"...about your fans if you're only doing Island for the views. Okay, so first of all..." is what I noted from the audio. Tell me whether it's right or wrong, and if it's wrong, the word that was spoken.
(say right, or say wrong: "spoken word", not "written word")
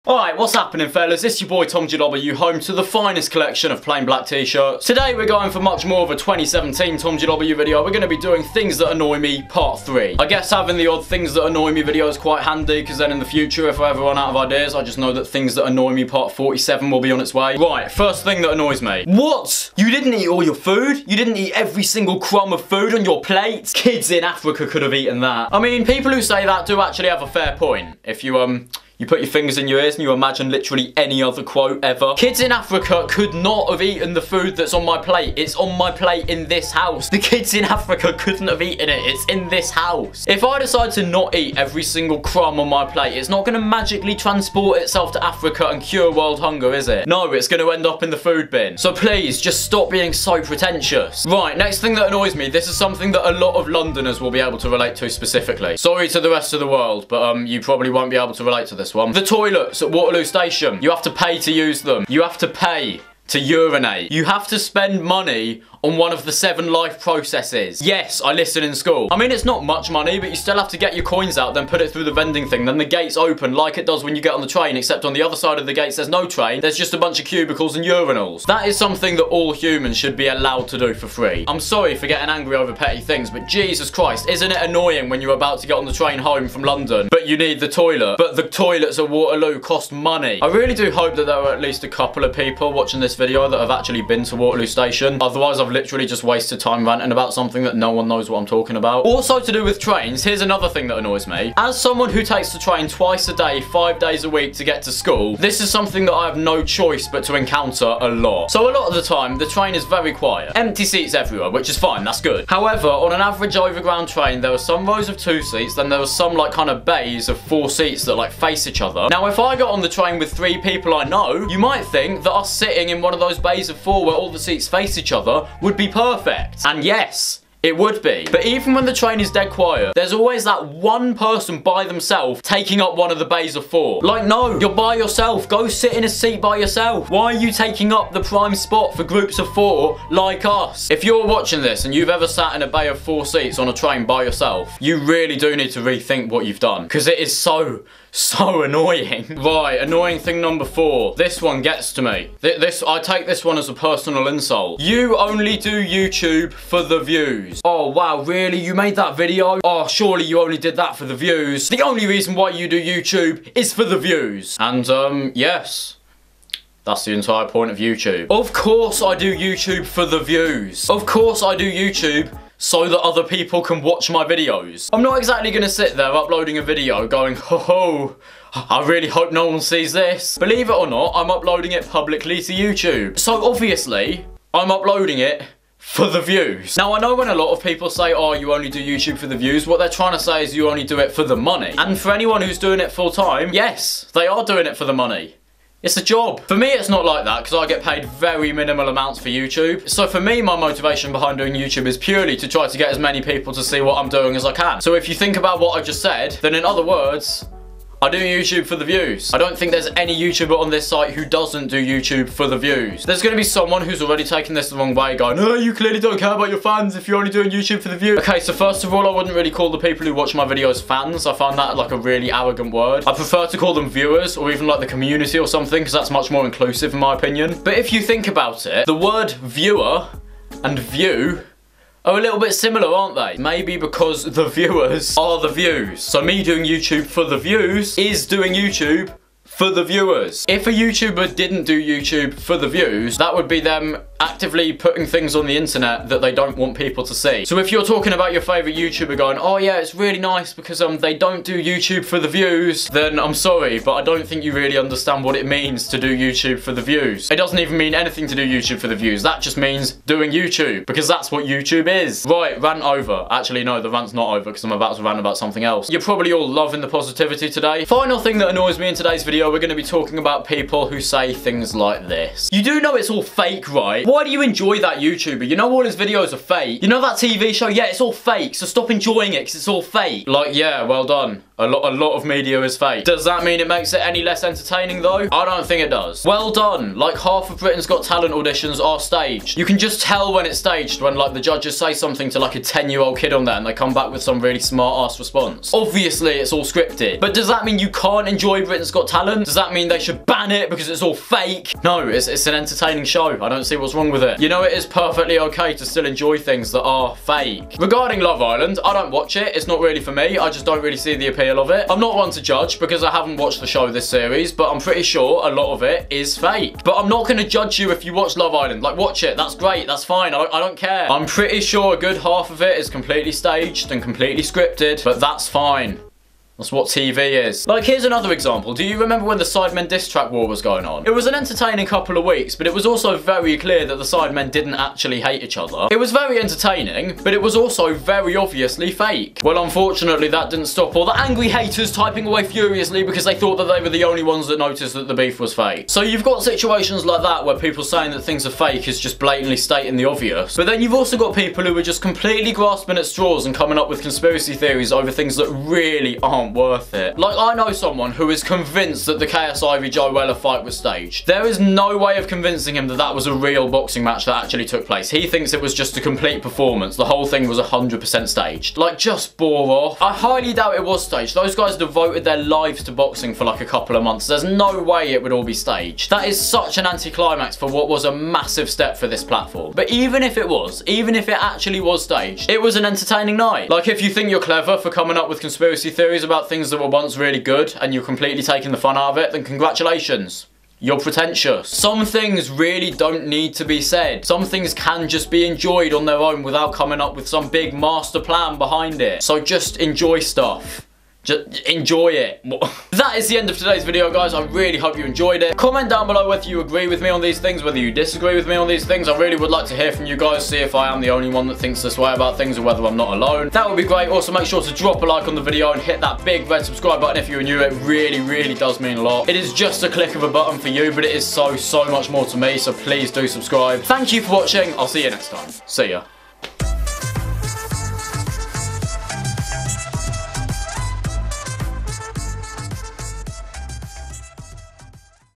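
wrong: "YouTube", not "Island".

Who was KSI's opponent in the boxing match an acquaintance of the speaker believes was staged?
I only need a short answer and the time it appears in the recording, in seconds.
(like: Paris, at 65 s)
Joe Weller, at 359 s.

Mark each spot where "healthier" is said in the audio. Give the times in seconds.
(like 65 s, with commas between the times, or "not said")
not said.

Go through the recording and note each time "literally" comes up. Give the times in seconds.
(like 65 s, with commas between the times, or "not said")
30 s, 95 s.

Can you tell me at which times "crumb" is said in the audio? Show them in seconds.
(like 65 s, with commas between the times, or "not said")
22 s, 42 s.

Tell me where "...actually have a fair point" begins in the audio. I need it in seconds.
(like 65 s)
26 s.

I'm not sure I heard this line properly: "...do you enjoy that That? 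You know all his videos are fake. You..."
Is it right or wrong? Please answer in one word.
wrong.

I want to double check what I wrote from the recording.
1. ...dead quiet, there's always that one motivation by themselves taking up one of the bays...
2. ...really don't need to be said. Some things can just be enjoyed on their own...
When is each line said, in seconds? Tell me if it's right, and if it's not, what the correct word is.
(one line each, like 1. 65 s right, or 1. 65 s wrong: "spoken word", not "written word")
1. 129 s wrong: "person", not "motivation"
2. 392 s right.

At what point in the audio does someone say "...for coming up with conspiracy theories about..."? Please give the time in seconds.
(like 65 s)
384 s.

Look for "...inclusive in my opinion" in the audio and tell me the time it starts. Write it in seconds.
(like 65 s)
226 s.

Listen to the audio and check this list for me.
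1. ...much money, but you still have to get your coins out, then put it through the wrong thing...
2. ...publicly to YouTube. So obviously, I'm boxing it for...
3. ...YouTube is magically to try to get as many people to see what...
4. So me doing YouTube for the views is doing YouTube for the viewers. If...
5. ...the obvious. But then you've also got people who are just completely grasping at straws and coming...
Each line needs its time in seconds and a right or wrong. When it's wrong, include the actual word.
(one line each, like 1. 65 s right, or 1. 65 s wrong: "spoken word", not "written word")
1. 69 s wrong: "vending", not "wrong"
2. 181 s wrong: "uploading", not "boxing"
3. 201 s wrong: "purely", not "magically"
4. 236 s right
5. 349 s right.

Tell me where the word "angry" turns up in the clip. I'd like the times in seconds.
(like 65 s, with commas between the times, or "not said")
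82 s, 341 s.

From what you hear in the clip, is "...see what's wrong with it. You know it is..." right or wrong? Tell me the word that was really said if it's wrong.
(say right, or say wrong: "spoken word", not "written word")
right.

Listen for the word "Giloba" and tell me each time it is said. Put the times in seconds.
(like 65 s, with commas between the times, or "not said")
1 s, 7 s.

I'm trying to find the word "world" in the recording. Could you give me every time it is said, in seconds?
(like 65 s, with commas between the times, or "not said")
46 s, 56 s.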